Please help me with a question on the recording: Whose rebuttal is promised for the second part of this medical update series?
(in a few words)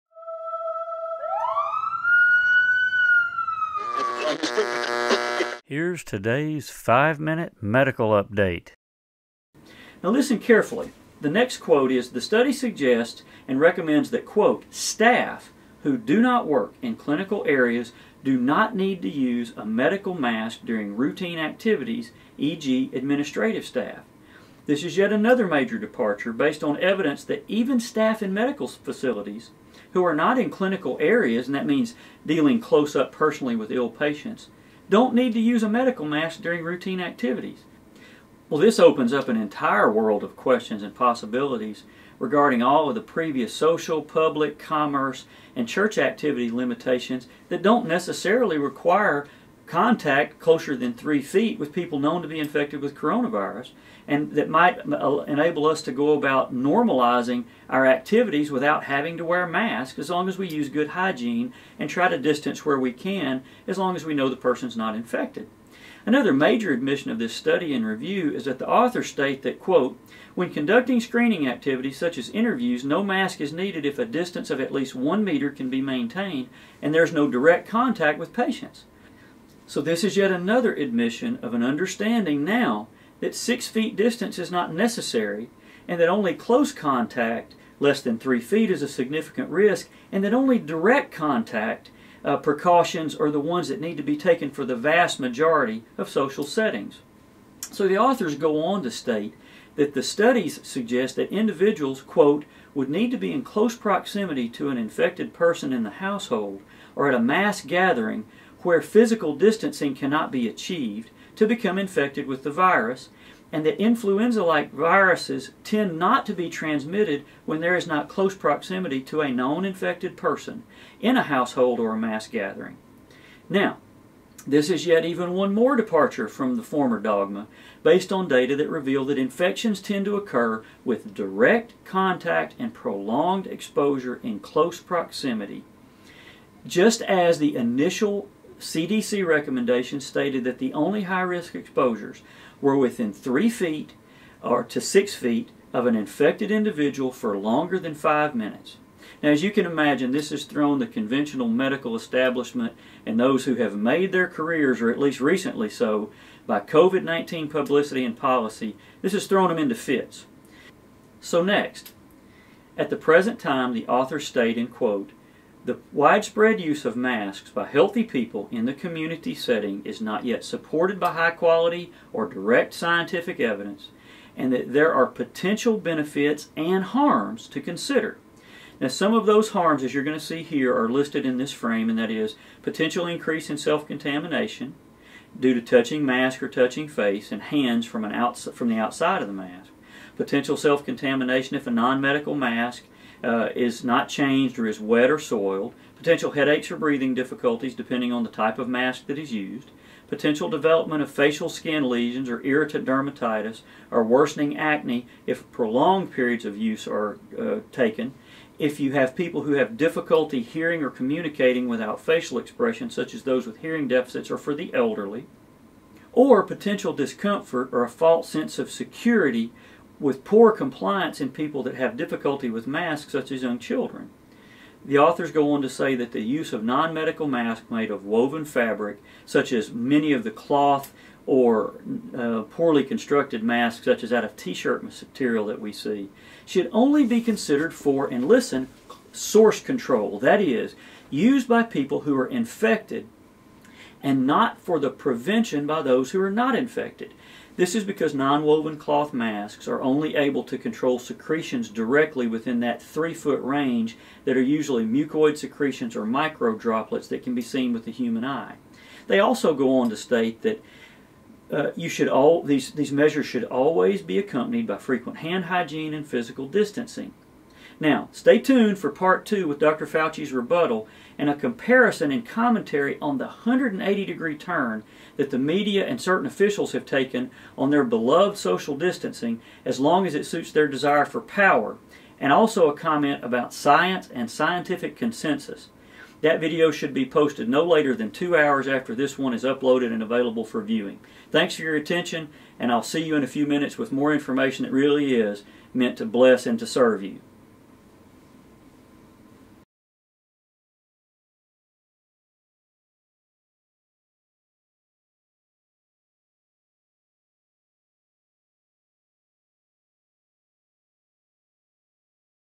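Dr. Fauci.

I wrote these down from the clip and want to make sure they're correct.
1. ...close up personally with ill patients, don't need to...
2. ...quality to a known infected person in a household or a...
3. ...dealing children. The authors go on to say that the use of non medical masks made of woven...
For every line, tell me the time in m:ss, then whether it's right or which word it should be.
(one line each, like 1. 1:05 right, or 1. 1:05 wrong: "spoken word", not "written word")
1. 0:32 right
2. 1:58 wrong: "proximity", not "quality"
3. 3:43 wrong: "young", not "dealing".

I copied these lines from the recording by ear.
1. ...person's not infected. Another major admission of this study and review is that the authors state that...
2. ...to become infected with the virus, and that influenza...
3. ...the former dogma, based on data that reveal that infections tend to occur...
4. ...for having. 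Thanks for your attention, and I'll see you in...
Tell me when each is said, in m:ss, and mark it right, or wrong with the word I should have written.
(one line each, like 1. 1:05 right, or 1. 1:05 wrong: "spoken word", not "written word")
1. 1:04 right
2. 1:51 right
3. 2:06 right
4. 4:50 wrong: "viewing", not "having".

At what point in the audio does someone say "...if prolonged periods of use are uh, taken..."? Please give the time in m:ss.
3:25.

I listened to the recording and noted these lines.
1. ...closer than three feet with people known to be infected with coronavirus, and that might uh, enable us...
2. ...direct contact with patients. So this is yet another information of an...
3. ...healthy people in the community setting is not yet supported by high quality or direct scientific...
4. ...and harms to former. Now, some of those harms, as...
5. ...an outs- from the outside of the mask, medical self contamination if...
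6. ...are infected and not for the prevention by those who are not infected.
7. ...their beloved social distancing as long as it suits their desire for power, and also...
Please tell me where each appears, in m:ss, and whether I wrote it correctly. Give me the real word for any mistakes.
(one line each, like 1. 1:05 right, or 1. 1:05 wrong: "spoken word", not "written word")
1. 0:50 right
2. 1:17 wrong: "admission", not "information"
3. 2:47 right
4. 2:56 wrong: "consider", not "former"
5. 3:08 wrong: "potential", not "medical"
6. 4:02 right
7. 4:37 right.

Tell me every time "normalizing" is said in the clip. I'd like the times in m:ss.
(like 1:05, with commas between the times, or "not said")
0:56.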